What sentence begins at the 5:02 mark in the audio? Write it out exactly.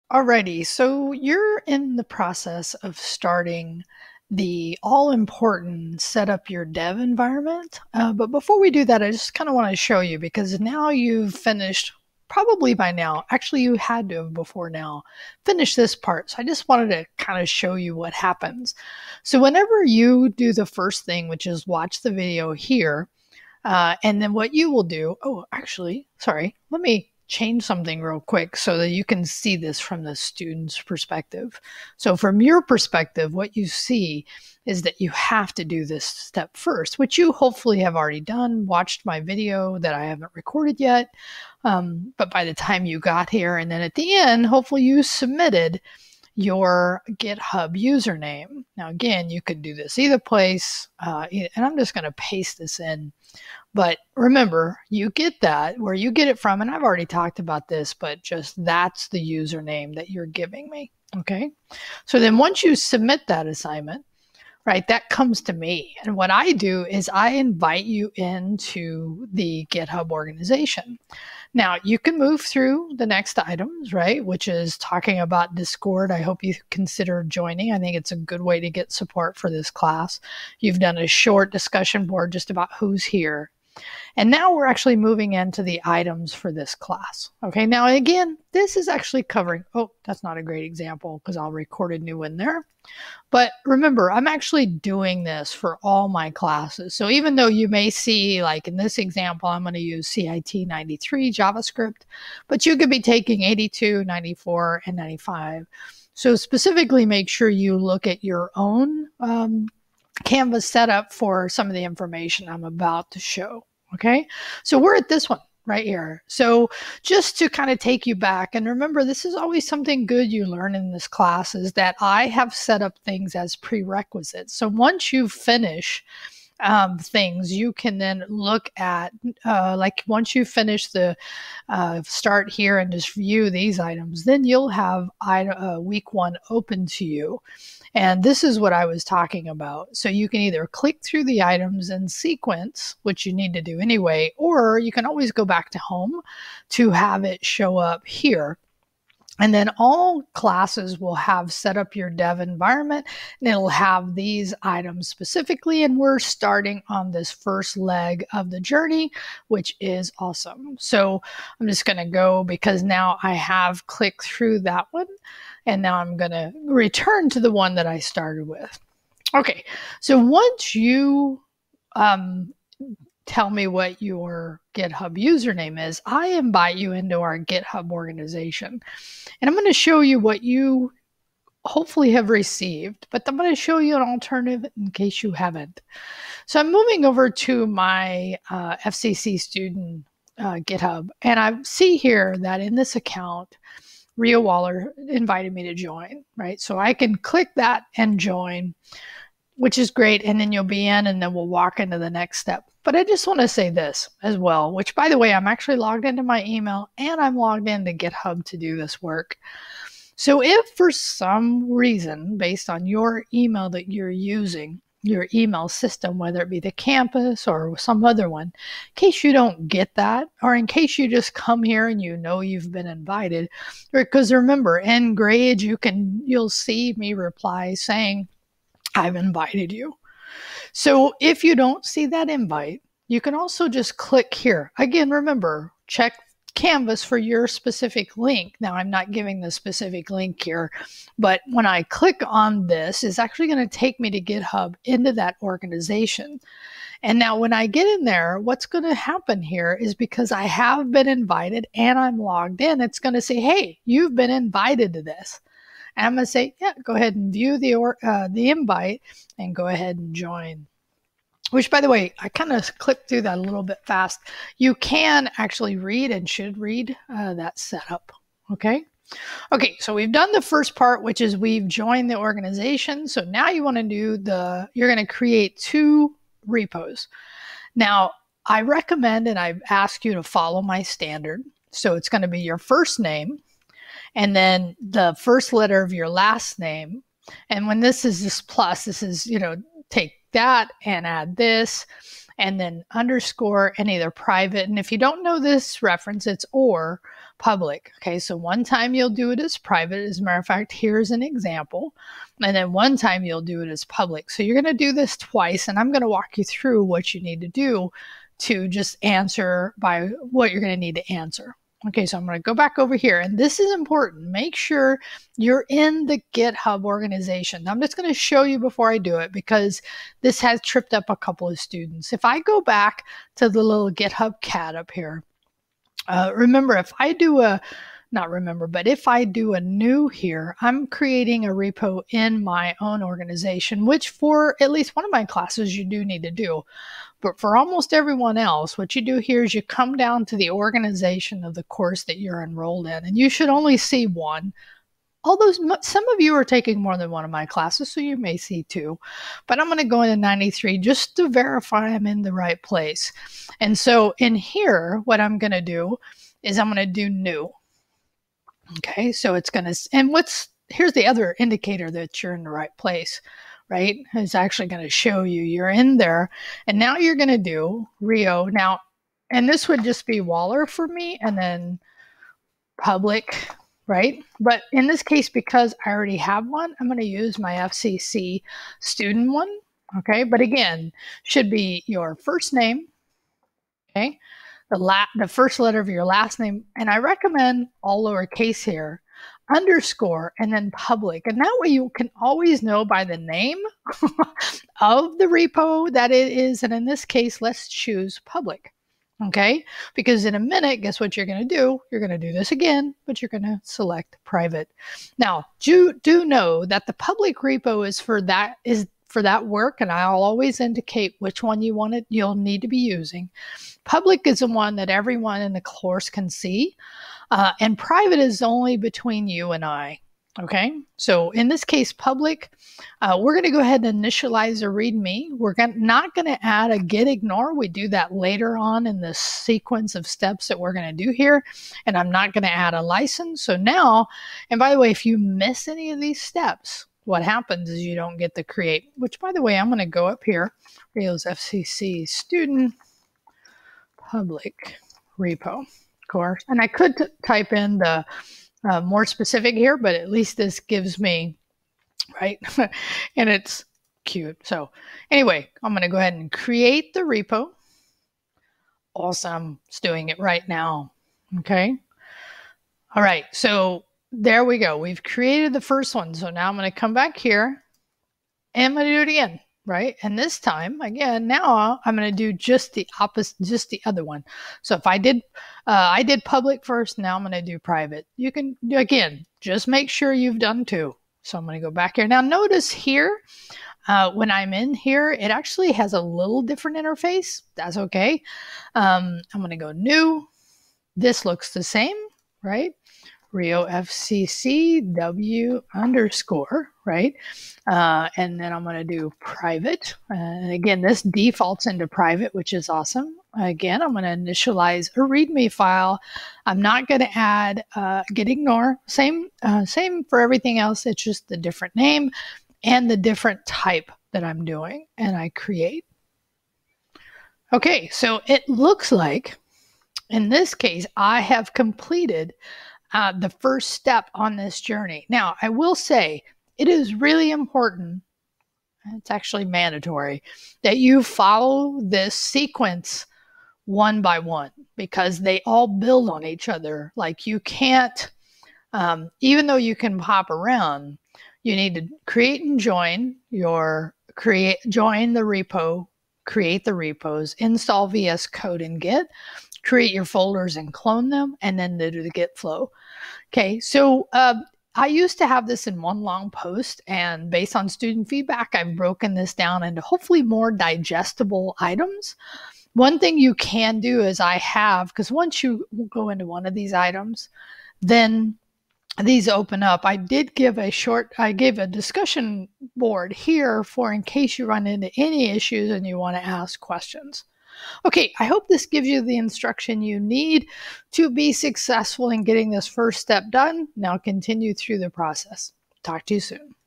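And then one time you'll do it as public.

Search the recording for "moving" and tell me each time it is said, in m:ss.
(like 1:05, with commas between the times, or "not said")
1:24, 3:06.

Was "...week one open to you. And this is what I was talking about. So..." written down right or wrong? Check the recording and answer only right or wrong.
right.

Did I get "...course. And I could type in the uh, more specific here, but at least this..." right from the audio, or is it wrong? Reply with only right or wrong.
right.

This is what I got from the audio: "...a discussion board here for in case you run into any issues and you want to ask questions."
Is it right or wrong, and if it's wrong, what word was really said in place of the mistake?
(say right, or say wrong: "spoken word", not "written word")
right.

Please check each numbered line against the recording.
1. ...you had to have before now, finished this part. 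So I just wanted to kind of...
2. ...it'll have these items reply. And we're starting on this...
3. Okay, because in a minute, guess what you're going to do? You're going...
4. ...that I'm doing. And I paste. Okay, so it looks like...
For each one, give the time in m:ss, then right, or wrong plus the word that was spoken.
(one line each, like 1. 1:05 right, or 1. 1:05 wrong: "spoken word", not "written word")
1. 0:13 right
2. 2:33 wrong: "specifically", not "reply"
3. 6:39 right
4. 8:34 wrong: "create", not "paste".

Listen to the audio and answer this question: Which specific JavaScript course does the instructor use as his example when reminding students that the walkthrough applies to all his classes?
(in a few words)
CIT 93.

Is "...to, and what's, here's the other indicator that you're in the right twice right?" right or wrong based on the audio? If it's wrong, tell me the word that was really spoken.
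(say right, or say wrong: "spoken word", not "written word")
wrong: "place", not "twice".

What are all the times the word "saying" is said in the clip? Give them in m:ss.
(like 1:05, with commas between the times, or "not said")
3:47.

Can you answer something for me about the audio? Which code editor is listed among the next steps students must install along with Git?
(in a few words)
VS Code.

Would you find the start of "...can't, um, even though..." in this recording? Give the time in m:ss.
8:57.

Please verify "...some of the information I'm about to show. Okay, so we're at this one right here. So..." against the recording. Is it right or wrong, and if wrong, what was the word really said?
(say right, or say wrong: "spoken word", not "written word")
right.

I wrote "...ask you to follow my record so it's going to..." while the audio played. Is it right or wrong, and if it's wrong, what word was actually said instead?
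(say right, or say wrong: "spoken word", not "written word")
wrong: "standard", not "record".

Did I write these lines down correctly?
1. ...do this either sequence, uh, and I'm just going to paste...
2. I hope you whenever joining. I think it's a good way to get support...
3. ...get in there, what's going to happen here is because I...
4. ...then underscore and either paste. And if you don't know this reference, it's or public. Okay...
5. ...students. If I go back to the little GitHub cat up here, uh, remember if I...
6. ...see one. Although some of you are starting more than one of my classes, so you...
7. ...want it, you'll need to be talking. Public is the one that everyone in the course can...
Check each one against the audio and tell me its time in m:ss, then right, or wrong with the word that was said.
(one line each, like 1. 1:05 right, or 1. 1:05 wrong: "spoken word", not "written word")
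1. 0:49 wrong: "place", not "sequence"
2. 1:16 wrong: "consider", not "whenever"
3. 4:07 right
4. 4:52 wrong: "private", not "paste"
5. 5:21 right
6. 5:43 wrong: "taking", not "starting"
7. 6:51 wrong: "using", not "talking".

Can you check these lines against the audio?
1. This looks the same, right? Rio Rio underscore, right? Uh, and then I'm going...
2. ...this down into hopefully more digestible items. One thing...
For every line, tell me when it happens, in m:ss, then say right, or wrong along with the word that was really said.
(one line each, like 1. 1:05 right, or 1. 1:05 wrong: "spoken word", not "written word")
1. 8:10 wrong: "FCCW", not "Rio"
2. 9:19 right.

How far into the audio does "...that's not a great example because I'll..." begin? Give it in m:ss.
1:30.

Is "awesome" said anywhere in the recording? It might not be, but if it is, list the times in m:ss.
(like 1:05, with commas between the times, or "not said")
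2:40, 7:38, 8:22.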